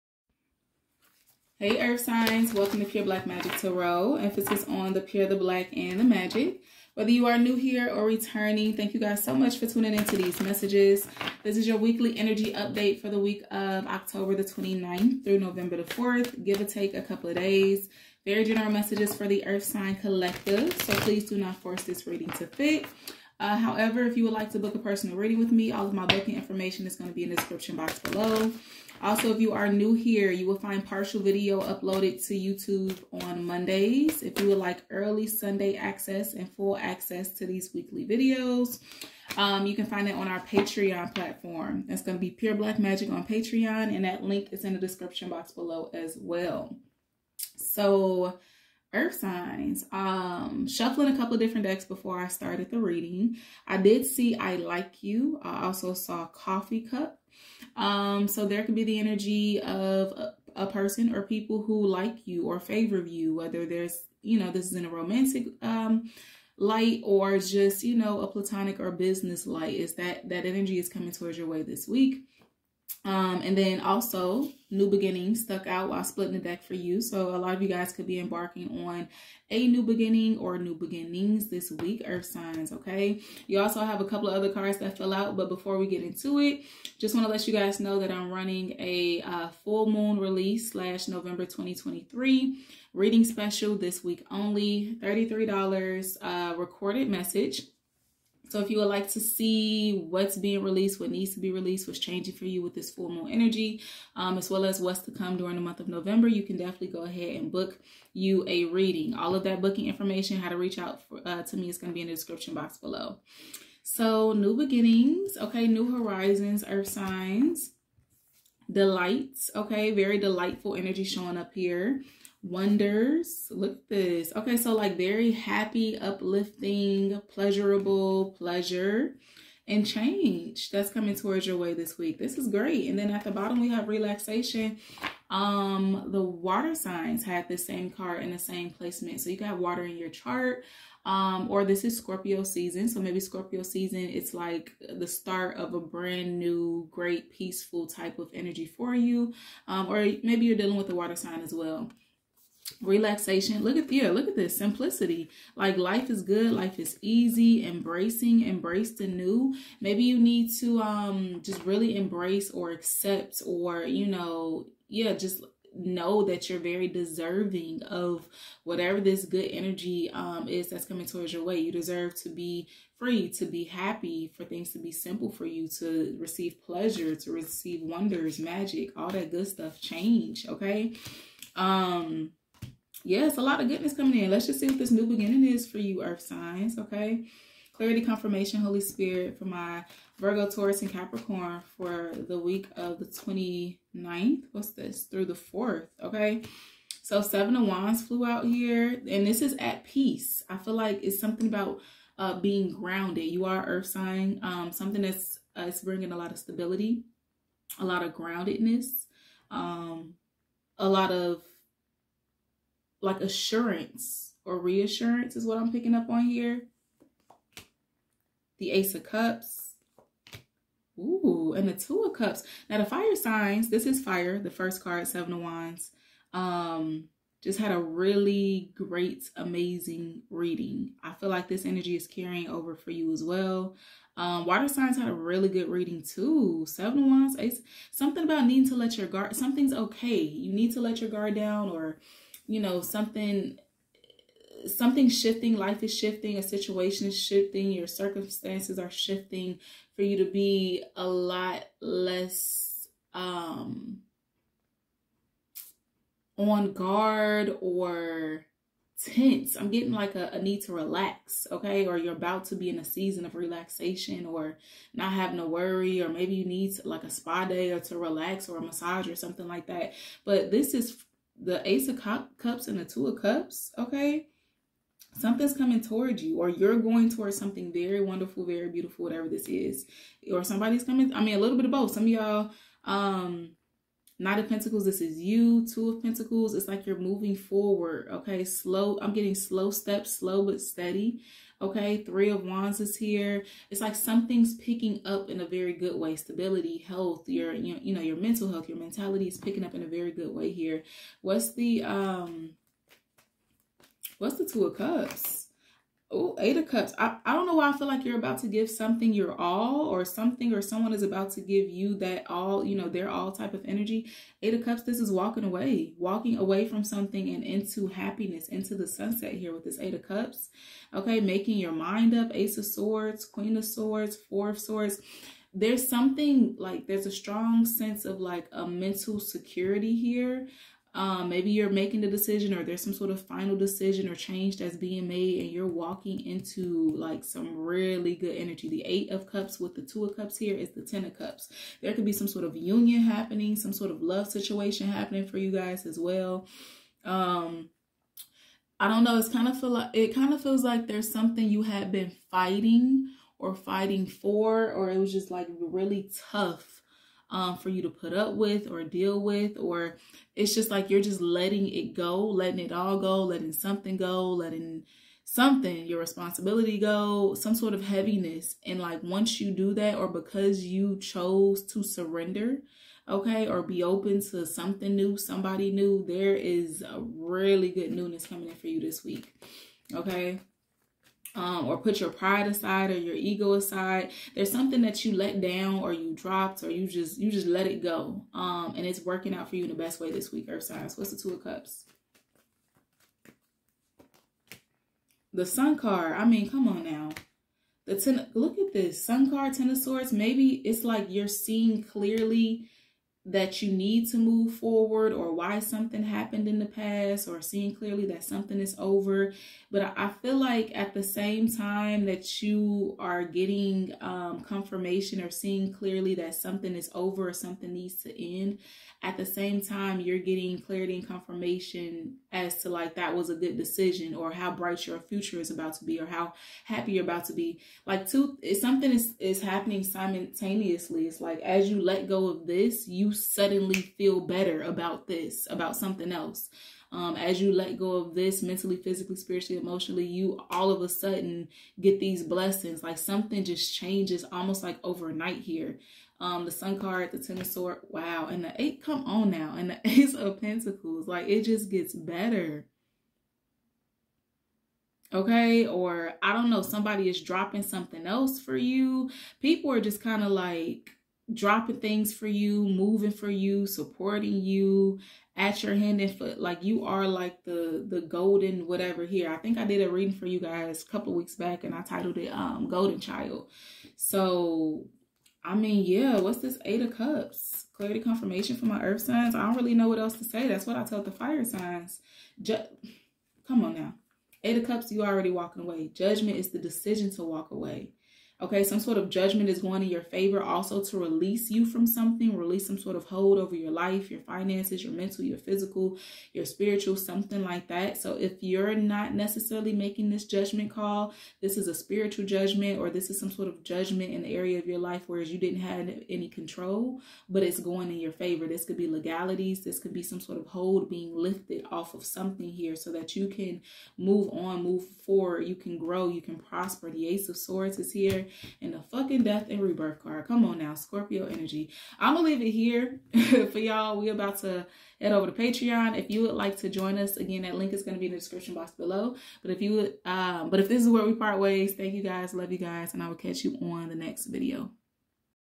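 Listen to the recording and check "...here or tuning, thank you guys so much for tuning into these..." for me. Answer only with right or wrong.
wrong.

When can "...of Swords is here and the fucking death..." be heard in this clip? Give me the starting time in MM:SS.
08:37.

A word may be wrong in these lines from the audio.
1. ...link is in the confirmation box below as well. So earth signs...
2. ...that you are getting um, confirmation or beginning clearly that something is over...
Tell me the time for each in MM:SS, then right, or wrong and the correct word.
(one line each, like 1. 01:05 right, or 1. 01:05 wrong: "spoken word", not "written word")
1. 00:44 wrong: "description", not "confirmation"
2. 06:52 wrong: "seeing", not "beginning".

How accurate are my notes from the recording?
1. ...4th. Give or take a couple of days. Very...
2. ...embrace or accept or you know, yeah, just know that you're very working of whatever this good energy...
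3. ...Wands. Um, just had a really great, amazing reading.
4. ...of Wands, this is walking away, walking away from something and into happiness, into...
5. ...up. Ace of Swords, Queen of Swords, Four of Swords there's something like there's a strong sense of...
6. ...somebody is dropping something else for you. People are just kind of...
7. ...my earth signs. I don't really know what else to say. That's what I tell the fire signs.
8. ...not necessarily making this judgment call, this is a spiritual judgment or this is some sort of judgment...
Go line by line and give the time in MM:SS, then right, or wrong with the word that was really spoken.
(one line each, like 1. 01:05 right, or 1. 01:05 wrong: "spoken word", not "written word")
1. 00:15 right
2. 02:41 wrong: "deserving", not "working"
3. 03:45 right
4. 05:14 wrong: "Cups", not "Wands"
5. 05:22 right
6. 07:36 right
7. 07:58 right
8. 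08:18 right.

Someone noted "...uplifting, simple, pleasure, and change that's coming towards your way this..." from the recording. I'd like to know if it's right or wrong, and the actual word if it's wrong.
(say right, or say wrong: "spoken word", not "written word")
wrong: "pleasurable", not "simple".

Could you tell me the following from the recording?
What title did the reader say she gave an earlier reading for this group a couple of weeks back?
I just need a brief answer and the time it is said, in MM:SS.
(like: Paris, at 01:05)
Golden Child, at 07:52.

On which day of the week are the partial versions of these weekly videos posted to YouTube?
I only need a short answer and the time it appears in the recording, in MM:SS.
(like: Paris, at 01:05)
Mondays, at 00:33.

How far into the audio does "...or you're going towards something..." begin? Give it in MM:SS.
04:36.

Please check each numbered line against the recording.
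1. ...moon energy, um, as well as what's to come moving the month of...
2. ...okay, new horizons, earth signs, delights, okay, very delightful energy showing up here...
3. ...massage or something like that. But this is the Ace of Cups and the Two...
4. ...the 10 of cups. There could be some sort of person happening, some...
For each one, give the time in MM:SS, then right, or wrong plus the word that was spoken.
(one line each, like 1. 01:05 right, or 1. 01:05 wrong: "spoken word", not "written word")
1. 01:43 wrong: "during", not "moving"
2. 01:55 right
3. 04:28 right
4. 05:40 wrong: "union", not "person".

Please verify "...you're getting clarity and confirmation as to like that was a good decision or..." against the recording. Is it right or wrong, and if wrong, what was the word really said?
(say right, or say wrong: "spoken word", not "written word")
right.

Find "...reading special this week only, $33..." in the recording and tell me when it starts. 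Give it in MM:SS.
01:32.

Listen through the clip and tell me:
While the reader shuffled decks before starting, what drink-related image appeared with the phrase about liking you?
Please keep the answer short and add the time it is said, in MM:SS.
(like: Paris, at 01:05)
coffee cup, at 00:56.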